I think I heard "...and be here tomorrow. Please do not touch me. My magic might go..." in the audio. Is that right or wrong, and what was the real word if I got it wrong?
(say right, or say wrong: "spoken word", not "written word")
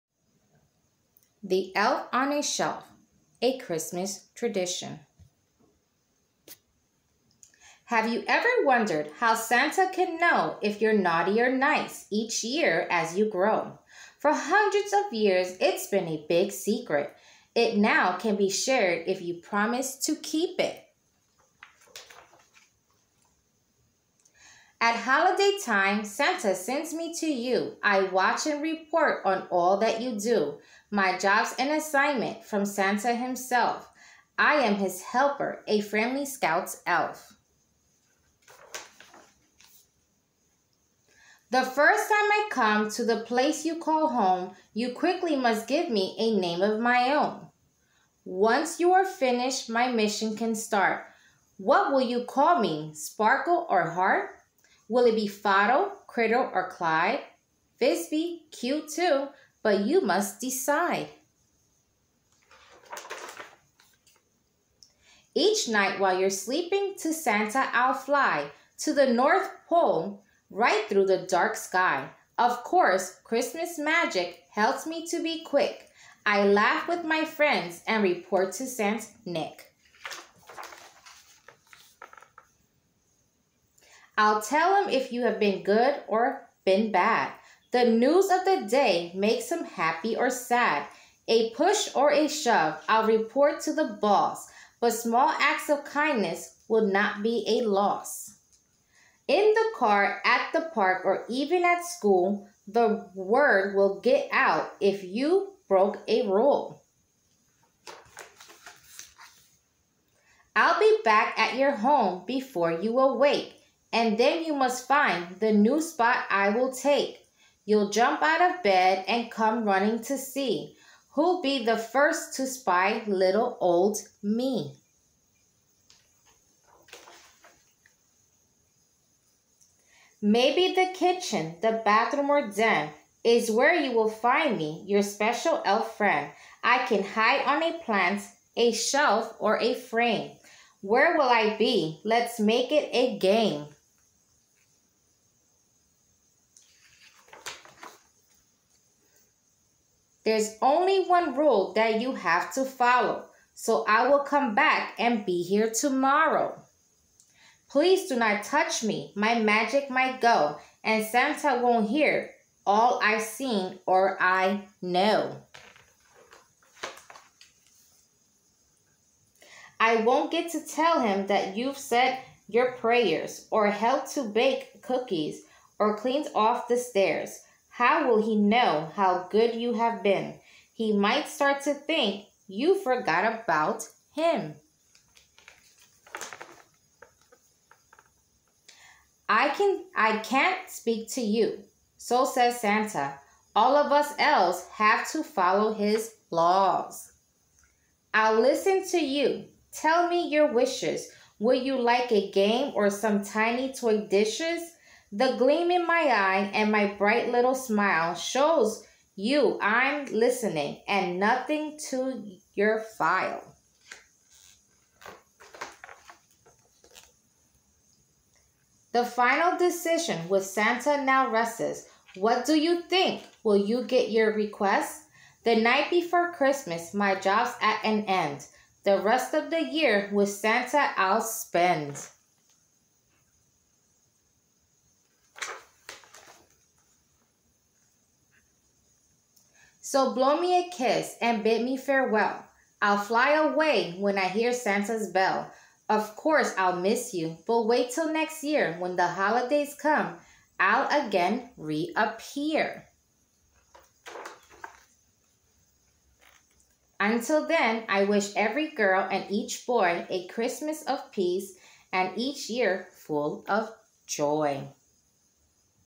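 right.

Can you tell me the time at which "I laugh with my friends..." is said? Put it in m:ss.
1:16.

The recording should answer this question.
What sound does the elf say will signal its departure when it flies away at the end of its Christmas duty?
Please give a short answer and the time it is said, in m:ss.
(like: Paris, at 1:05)
Santa's bell, at 4:04.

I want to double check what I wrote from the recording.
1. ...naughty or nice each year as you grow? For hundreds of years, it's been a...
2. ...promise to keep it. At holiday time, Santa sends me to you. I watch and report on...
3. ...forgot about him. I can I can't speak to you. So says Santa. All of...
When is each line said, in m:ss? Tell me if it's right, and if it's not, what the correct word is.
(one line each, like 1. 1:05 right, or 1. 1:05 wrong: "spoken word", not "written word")
1. 0:10 right
2. 0:19 right
3. 3:02 right.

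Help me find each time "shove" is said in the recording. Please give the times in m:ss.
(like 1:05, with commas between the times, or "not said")
1:32.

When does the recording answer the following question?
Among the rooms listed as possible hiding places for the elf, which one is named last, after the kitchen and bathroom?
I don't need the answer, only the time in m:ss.
2:12.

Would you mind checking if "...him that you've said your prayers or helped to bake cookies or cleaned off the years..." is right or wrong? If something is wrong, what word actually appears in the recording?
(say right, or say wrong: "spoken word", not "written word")
wrong: "stairs", not "years".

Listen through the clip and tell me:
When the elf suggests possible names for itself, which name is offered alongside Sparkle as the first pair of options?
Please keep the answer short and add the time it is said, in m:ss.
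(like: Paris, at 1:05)
Heart, at 0:53.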